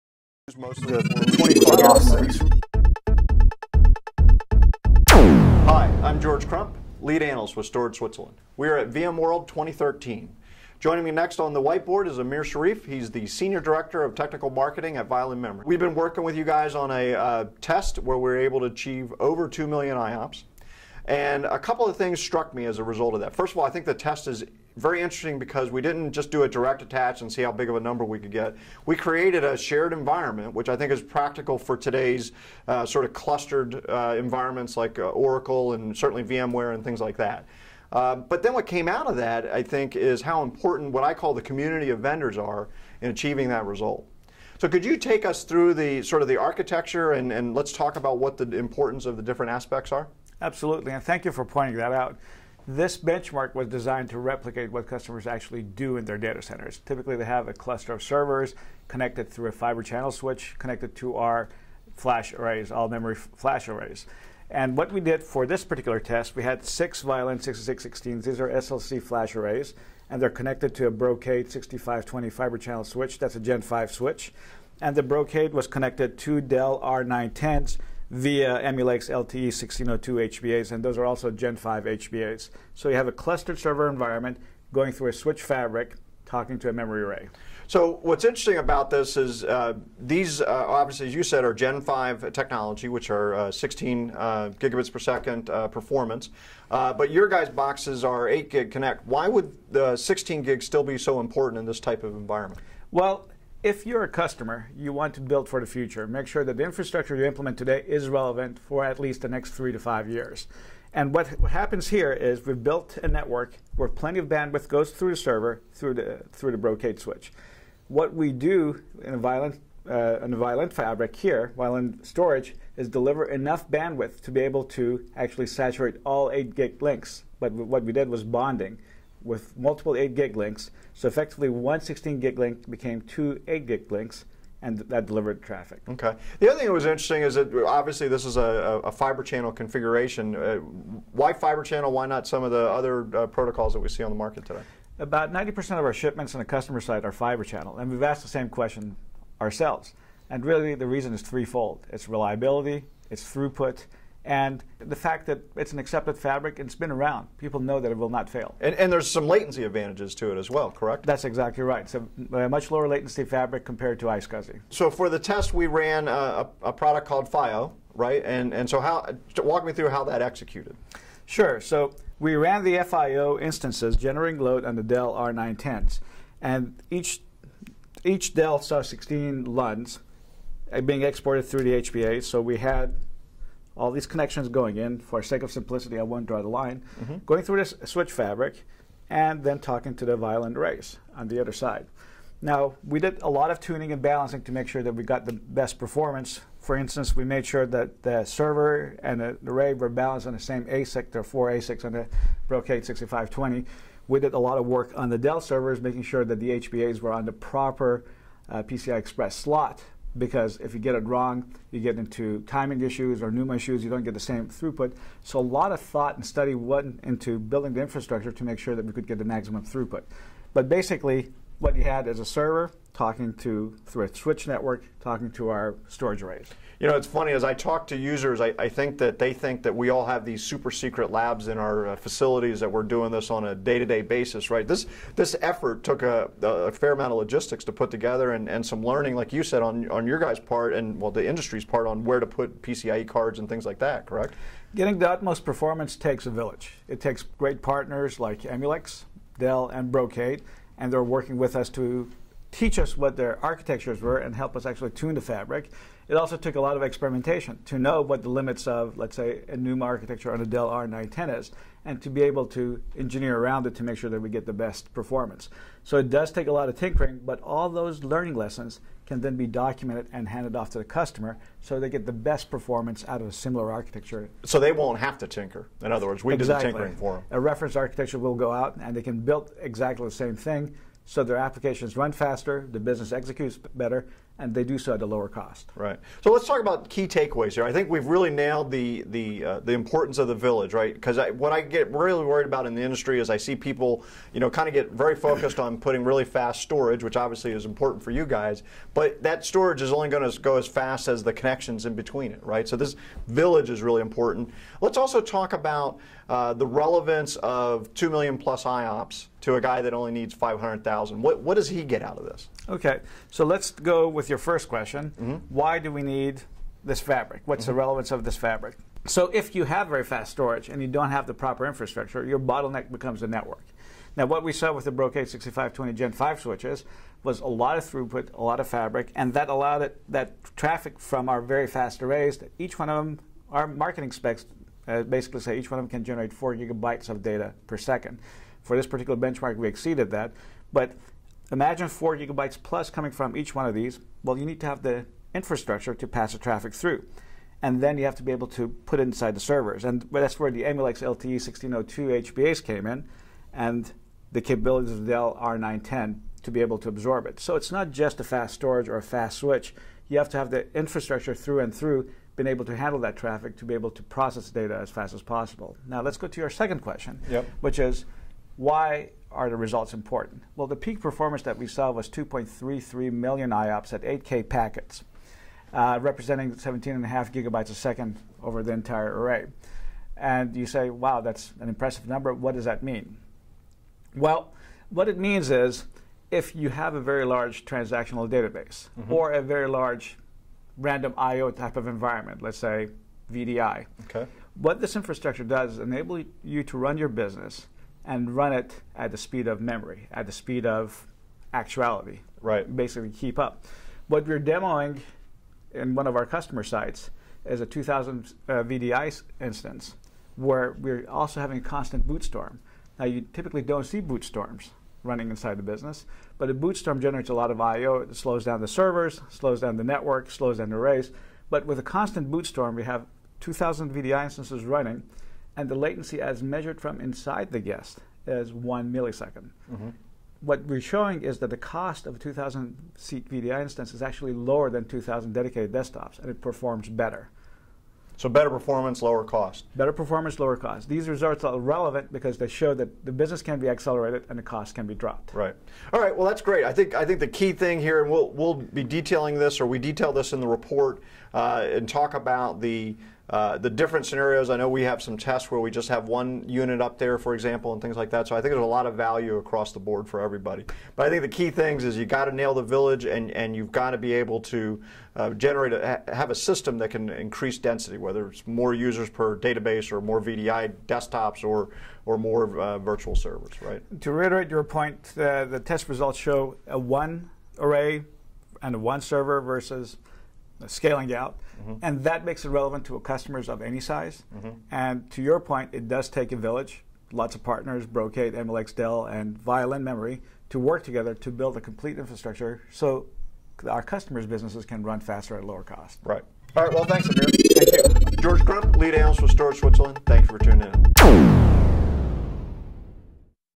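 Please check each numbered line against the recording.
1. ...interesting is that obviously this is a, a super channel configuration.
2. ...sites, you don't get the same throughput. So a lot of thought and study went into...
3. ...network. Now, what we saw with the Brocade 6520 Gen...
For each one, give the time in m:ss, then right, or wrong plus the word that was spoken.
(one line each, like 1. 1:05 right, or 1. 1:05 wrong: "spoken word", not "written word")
1. 2:16 wrong: "fiber", not "super"
2. 3:33 wrong: "issues", not "sites"
3. 5:23 right.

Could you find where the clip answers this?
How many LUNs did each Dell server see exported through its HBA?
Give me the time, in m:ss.
2:58.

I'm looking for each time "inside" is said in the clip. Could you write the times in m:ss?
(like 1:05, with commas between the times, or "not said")
5:49, 6:55, 7:07.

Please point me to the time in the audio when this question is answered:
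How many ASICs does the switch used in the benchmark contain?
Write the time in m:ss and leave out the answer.
3:21.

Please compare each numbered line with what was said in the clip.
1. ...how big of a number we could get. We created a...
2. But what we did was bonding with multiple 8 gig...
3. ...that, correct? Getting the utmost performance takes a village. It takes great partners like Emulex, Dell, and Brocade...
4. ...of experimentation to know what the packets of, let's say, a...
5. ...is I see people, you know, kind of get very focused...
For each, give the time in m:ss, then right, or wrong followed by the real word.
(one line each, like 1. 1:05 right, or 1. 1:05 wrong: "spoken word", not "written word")
1. 0:27 right
2. 2:07 right
3. 4:03 right
4. 4:16 wrong: "limits", not "packets"
5. 4:53 right.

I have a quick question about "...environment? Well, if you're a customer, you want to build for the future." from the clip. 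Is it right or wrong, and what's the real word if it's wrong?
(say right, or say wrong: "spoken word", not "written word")
right.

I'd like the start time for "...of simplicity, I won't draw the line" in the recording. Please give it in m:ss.
3:05.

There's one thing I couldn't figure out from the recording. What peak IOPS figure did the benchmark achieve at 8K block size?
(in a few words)
2.33 million.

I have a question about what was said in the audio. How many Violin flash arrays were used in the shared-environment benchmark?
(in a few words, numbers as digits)
6.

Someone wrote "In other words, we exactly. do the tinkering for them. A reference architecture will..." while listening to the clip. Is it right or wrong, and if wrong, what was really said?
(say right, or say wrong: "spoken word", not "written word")
right.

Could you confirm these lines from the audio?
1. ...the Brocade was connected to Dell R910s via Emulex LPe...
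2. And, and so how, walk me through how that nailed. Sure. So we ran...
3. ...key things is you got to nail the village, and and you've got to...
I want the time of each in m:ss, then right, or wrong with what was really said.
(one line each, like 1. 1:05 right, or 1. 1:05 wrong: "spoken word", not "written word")
1. 1:14 right
2. 2:48 wrong: "executed", not "nailed"
3. 7:41 right.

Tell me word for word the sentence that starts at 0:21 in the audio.
And a couple of things struck me as a result of that.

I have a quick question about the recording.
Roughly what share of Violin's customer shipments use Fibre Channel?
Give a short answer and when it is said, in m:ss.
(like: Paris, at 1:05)
90%, at 2:24.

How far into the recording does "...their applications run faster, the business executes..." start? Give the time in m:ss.
4:41.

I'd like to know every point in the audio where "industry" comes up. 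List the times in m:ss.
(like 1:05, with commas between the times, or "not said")
4:01, 4:52.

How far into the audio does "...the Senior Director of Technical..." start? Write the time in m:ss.
0:13.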